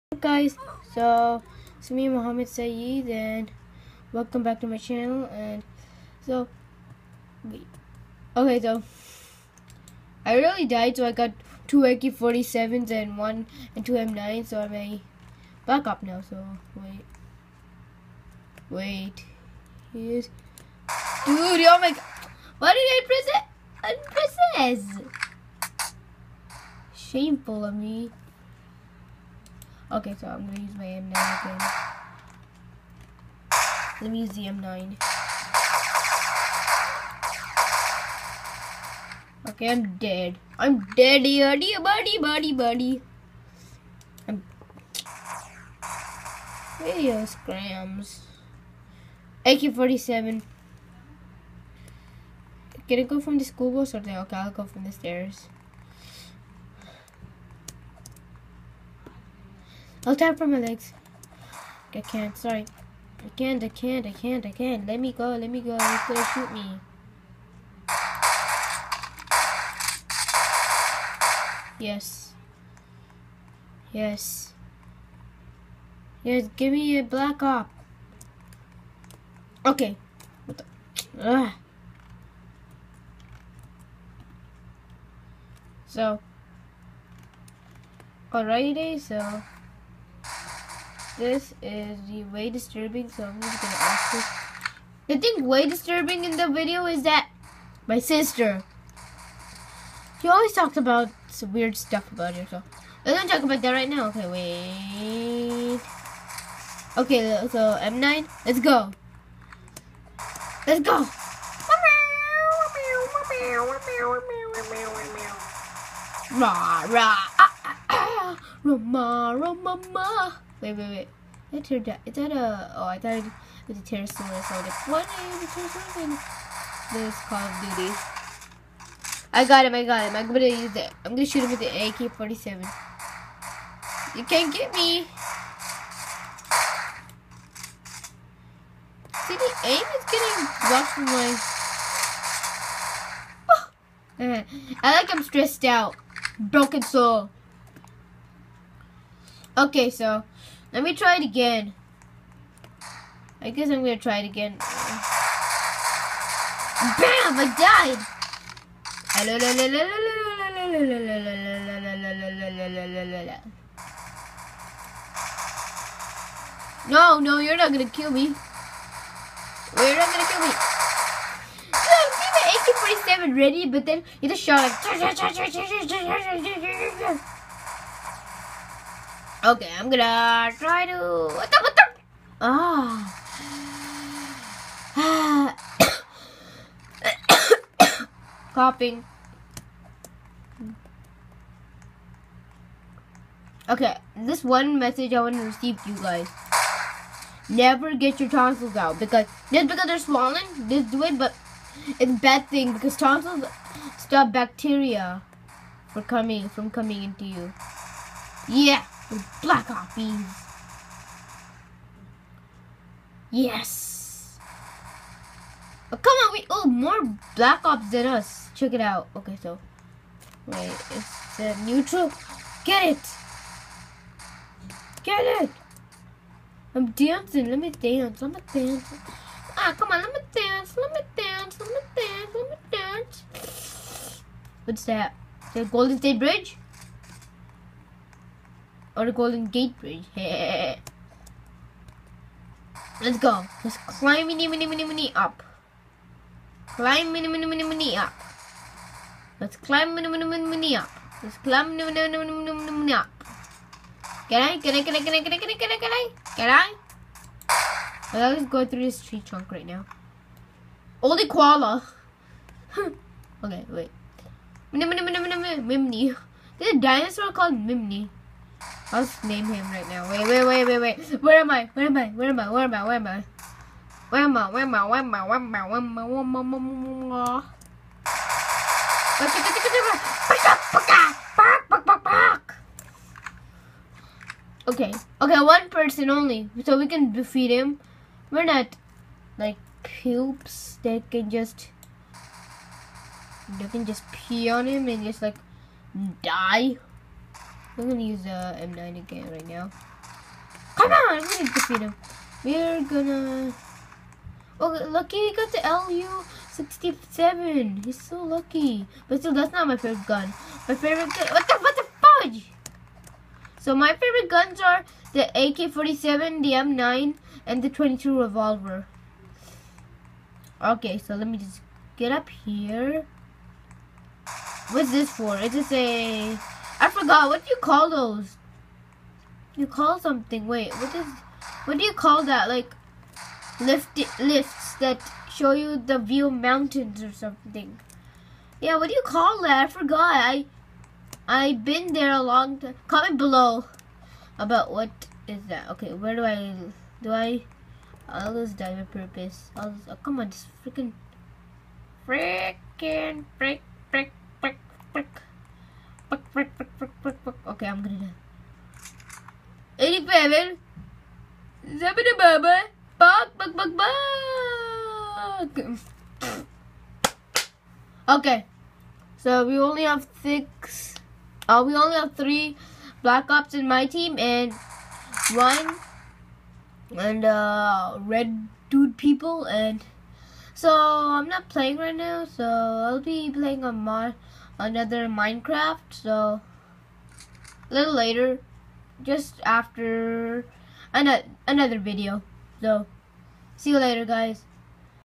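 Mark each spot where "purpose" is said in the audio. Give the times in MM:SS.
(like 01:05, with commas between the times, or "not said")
05:48.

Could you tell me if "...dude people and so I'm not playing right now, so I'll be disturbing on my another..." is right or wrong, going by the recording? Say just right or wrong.
wrong.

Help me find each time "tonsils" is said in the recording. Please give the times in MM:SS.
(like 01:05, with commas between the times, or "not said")
03:18, 03:22.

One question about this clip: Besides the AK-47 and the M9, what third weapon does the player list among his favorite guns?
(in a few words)
22 revolver.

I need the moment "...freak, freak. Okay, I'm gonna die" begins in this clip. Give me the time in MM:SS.
05:54.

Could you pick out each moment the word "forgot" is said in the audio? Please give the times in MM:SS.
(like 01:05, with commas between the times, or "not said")
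05:26, 05:39.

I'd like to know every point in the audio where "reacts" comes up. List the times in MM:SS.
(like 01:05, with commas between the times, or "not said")
not said.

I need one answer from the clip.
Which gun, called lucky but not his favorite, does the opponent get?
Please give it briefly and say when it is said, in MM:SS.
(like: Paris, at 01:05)
LU 67, at 05:05.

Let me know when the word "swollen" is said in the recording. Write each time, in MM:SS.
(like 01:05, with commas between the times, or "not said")
03:19.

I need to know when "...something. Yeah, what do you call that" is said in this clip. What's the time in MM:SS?
05:37.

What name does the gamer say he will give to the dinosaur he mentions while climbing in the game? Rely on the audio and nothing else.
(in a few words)
Mimni.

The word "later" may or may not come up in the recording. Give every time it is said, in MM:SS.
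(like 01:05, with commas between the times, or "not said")
06:27, 06:33.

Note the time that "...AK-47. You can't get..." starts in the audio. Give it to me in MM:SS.
02:11.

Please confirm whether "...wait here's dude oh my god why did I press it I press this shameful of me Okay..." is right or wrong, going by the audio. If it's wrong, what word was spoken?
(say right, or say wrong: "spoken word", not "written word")
right.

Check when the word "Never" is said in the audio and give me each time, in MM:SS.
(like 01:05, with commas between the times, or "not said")
03:17.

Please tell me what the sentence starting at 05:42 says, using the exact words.
Comment below about what is that.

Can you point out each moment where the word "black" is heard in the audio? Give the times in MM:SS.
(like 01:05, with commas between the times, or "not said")
01:17, 03:29, 03:37, 06:13.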